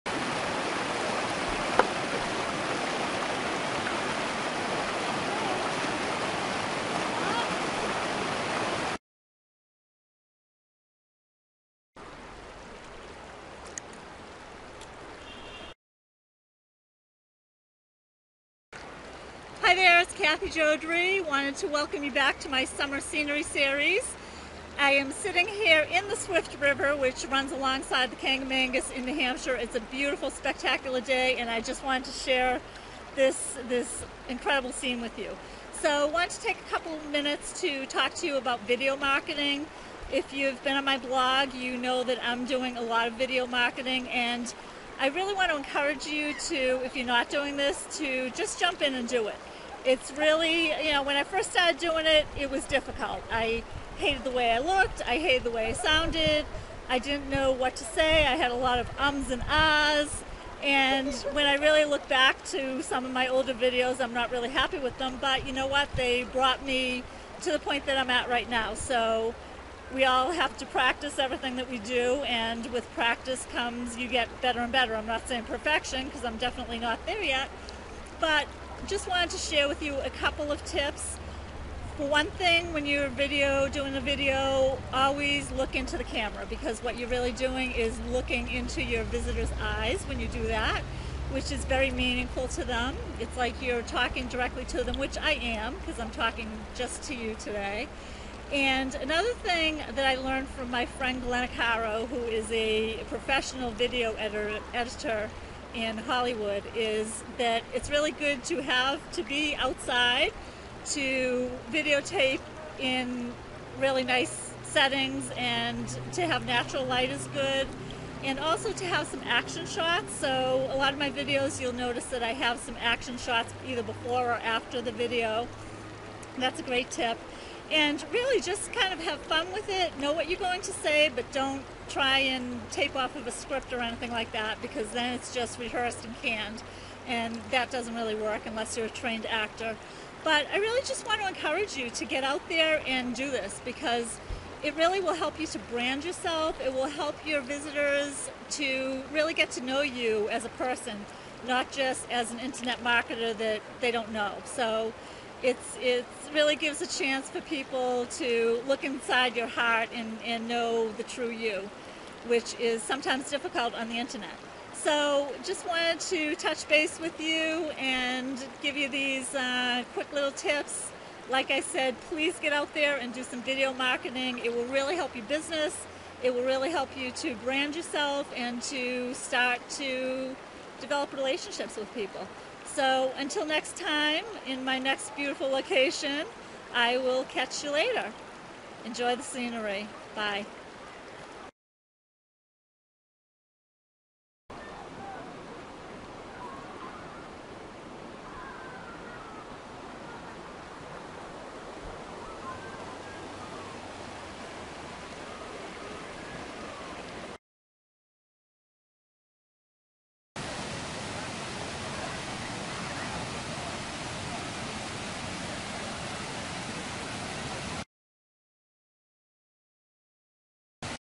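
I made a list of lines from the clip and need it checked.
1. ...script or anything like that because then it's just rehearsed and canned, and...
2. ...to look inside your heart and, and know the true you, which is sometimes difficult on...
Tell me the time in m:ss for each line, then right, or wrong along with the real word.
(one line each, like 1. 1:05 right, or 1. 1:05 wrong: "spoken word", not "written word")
1. 2:13 right
2. 2:38 right.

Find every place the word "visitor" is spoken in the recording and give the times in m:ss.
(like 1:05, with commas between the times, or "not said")
1:29, 2:27.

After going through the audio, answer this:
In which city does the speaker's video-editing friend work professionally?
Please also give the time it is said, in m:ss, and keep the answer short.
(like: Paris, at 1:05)
Hollywood, at 1:45.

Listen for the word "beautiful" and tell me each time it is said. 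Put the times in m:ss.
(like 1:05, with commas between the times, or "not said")
0:29, 3:05.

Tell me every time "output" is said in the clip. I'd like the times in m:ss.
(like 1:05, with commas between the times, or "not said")
not said.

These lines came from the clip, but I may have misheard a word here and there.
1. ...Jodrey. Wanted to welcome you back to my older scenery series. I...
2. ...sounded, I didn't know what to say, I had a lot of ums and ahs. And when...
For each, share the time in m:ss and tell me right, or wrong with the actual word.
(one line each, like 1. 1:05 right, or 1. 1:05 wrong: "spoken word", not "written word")
1. 0:20 wrong: "summer", not "older"
2. 0:55 right.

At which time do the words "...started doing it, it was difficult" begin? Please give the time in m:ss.
0:51.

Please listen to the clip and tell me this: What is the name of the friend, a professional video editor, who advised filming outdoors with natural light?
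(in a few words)
Glenna Caro.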